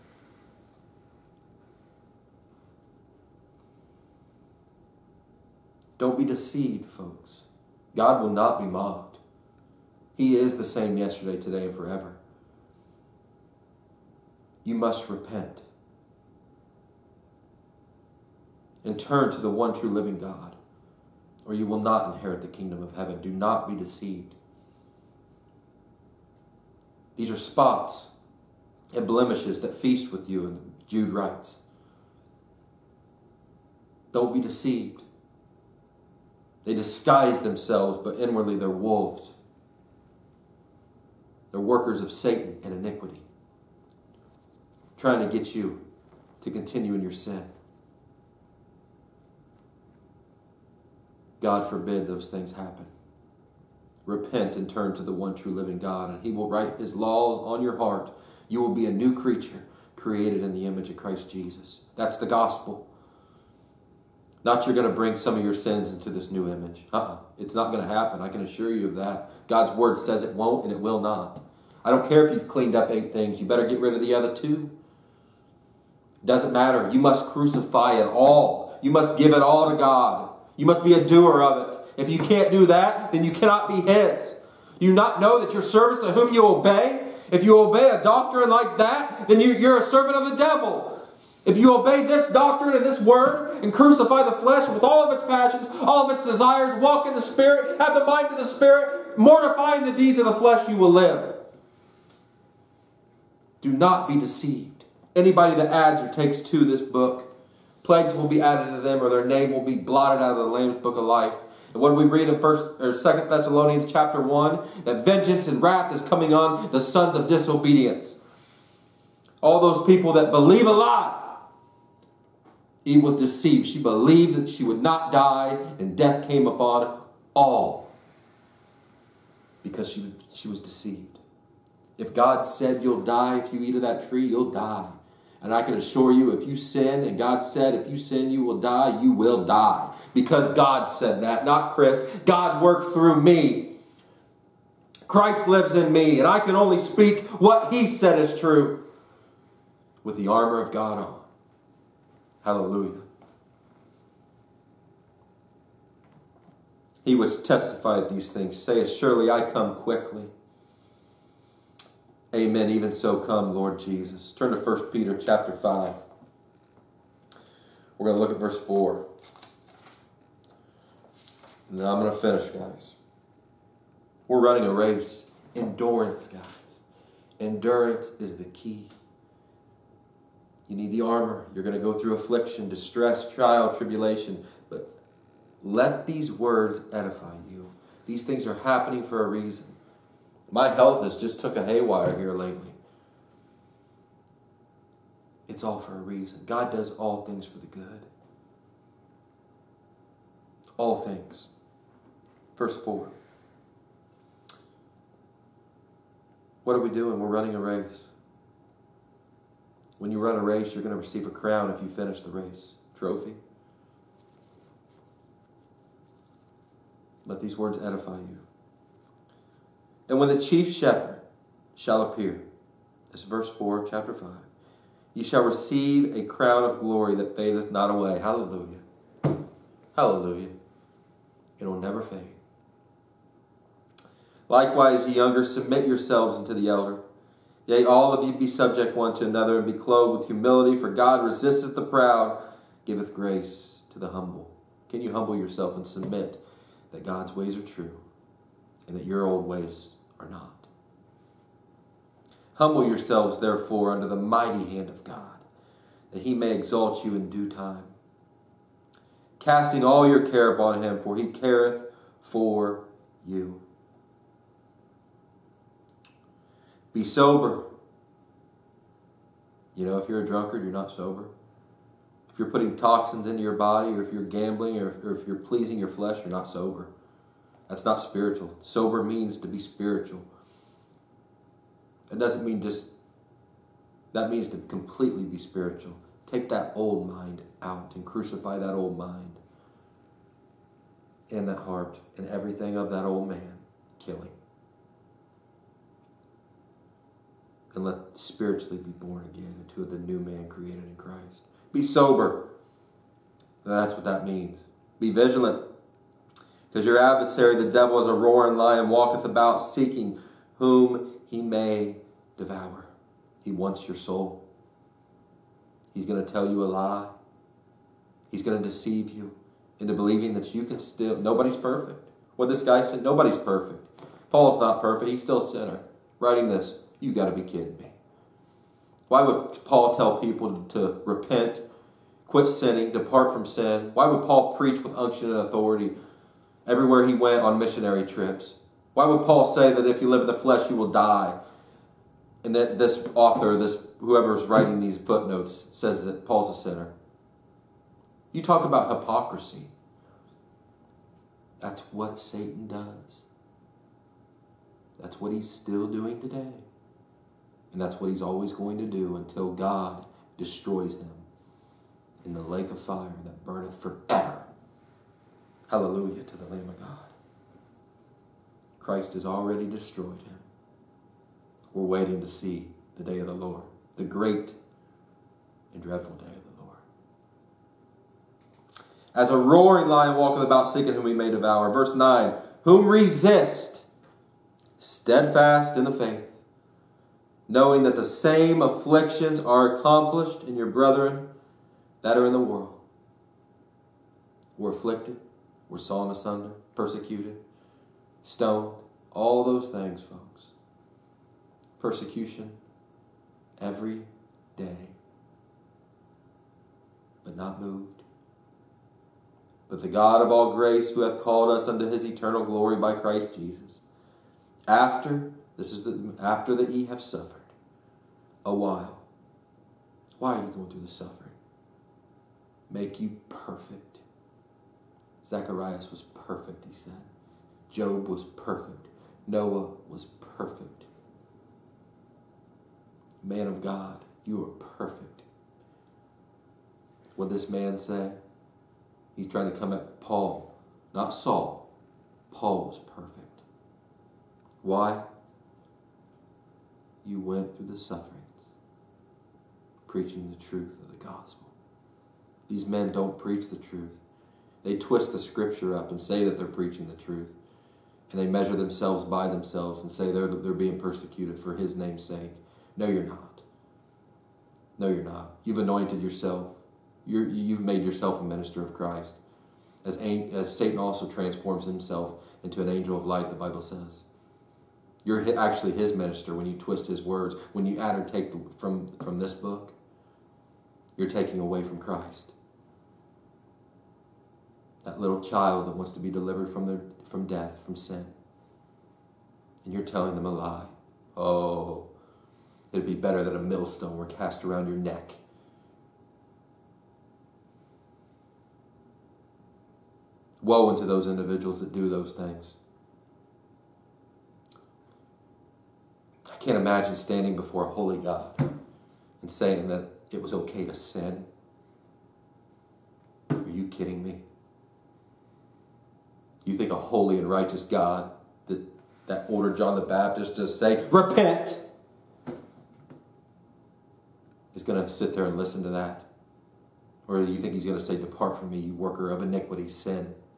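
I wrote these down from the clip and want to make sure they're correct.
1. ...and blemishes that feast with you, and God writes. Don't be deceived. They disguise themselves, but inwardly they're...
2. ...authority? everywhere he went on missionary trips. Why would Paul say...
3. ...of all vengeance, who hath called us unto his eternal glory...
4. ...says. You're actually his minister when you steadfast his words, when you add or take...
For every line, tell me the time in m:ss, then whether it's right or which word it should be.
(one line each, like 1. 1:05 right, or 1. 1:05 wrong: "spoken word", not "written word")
1. 0:28 wrong: "Jude", not "God"
2. 5:35 right
3. 6:50 wrong: "grace", not "vengeance"
4. 7:53 wrong: "twist", not "steadfast".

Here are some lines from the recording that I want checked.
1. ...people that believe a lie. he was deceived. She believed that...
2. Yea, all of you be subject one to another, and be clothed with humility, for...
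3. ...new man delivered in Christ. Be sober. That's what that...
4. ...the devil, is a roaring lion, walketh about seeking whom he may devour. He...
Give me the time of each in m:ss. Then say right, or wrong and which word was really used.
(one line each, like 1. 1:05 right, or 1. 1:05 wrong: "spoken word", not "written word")
1. 1:59 right
2. 3:57 right
3. 4:59 wrong: "created", not "delivered"
4. 5:07 right.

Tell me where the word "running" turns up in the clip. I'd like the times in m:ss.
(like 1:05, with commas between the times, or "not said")
2:54, 3:27.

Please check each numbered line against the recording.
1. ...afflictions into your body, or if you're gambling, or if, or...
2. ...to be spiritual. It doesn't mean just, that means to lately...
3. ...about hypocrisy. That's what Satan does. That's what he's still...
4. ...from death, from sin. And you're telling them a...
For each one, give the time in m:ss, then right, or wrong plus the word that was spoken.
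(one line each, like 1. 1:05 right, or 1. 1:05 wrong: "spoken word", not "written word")
1. 4:32 wrong: "toxins", not "afflictions"
2. 4:39 wrong: "completely", not "lately"
3. 5:48 right
4. 8:07 right.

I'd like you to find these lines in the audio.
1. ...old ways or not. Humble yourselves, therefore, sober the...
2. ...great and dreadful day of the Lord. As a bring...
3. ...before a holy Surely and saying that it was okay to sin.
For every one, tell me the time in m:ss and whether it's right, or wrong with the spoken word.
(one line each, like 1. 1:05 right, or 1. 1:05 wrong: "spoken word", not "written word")
1. 4:09 wrong: "under", not "sober"
2. 6:14 wrong: "roaring", not "bring"
3. 8:27 wrong: "God", not "Surely".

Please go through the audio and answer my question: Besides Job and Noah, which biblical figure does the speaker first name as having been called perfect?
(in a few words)
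Zacharias.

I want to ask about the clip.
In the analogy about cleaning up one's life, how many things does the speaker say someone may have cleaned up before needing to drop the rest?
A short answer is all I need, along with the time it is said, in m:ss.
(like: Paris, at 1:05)
8, at 1:12.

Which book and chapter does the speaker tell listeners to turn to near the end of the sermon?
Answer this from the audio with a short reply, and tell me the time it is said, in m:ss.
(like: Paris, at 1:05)
1 Peter chapter 5, at 2:44.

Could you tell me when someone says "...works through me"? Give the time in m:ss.
2:22.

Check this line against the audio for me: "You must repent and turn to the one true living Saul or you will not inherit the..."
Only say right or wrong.
wrong.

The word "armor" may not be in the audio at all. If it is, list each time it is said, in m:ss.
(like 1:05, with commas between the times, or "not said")
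2:30, 3:01.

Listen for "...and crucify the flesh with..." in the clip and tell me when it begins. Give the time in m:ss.
1:33.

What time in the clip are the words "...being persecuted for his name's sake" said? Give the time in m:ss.
7:40.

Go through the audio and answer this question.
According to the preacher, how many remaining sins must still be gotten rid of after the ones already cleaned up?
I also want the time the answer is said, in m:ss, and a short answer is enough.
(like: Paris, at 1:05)
2, at 1:14.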